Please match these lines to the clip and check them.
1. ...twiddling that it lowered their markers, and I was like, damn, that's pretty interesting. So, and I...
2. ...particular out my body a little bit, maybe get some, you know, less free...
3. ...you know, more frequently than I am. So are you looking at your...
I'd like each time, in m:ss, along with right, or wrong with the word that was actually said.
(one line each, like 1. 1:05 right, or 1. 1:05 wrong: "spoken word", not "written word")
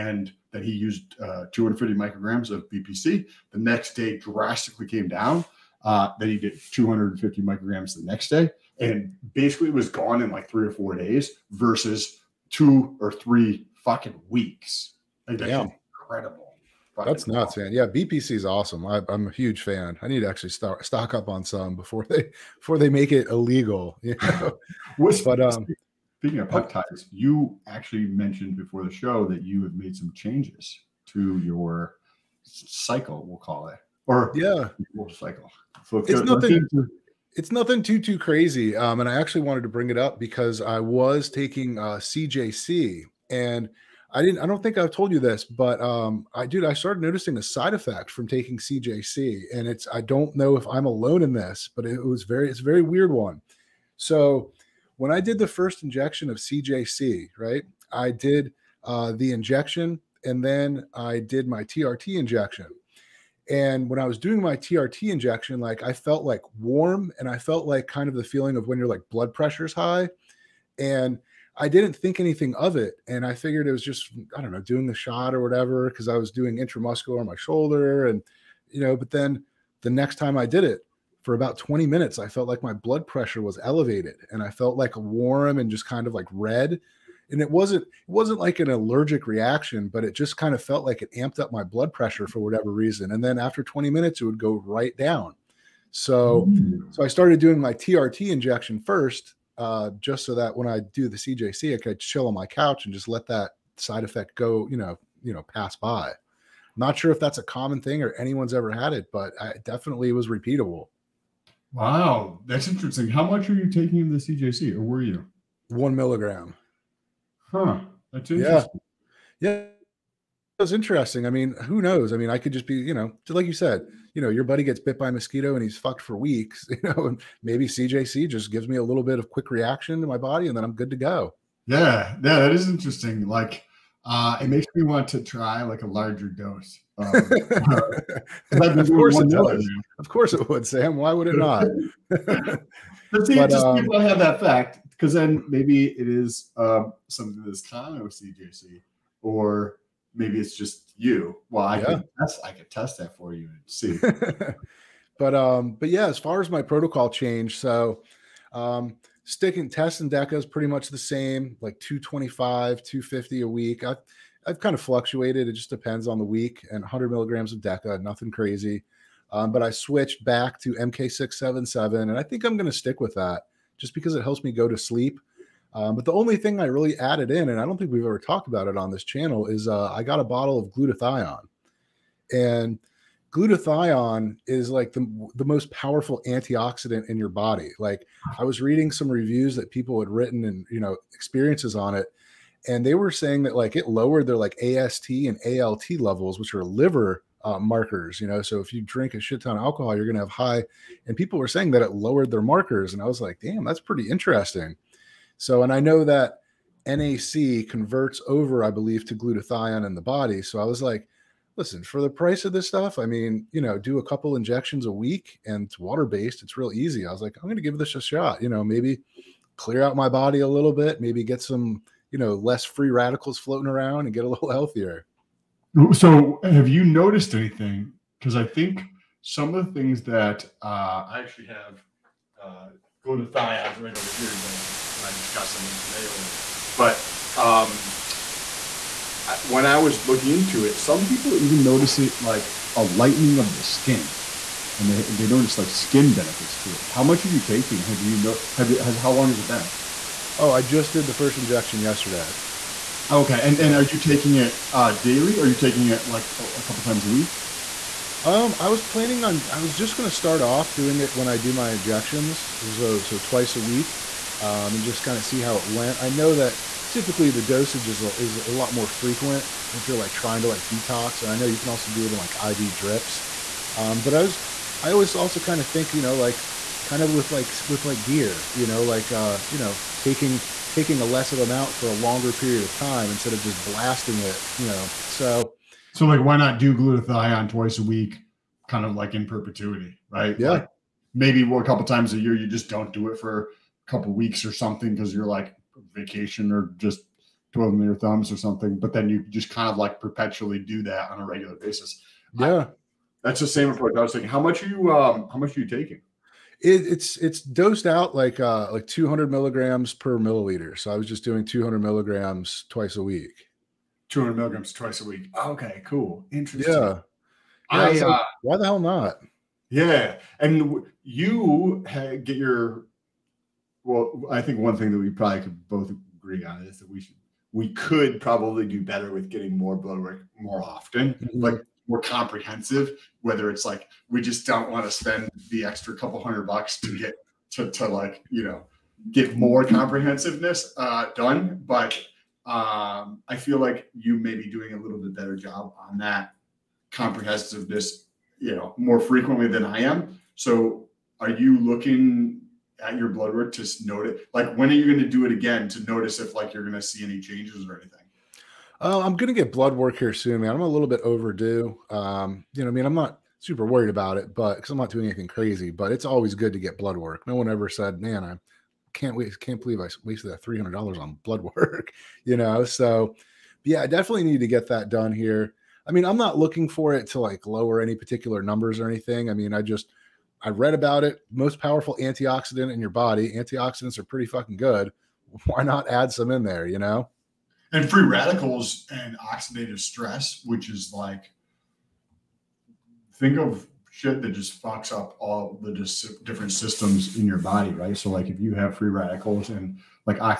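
1. 3:21 wrong: "saying", not "twiddling"
2. 3:39 wrong: "clear", not "particular"
3. 5:48 right.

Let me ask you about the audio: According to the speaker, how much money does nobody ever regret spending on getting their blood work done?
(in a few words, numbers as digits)
$300.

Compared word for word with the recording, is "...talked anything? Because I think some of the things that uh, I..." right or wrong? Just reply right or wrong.
wrong.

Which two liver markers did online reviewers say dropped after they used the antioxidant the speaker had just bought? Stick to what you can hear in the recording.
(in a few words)
AST and ALT.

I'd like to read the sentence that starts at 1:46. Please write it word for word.
Not sure if that's a common thing or anyone's ever had it, but I definitely was repeatable.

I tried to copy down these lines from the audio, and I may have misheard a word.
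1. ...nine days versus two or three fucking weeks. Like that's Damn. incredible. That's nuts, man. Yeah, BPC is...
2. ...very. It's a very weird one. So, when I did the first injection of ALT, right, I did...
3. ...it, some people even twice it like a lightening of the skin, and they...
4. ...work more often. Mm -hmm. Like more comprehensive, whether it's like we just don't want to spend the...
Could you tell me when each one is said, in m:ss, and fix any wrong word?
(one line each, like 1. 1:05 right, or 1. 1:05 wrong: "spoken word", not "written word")
1. 0:10 wrong: "four", not "nine"
2. 0:52 wrong: "CJC", not "ALT"
3. 4:00 wrong: "notice", not "twice"
4. 5:29 right.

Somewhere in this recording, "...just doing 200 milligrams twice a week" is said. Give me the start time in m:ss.
5:11.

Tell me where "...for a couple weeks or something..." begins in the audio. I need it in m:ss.
4:53.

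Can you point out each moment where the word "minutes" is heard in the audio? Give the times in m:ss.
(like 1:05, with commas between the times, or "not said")
1:21, 1:33.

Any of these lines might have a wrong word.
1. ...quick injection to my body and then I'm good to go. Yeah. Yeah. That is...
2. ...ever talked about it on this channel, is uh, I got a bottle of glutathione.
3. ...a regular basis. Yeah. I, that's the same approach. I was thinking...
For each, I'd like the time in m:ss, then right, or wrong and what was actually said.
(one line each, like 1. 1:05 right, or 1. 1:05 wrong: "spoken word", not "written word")
1. 2:09 wrong: "reaction", not "injection"
2. 2:58 right
3. 5:01 right.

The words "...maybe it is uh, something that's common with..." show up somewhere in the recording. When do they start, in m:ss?
2:25.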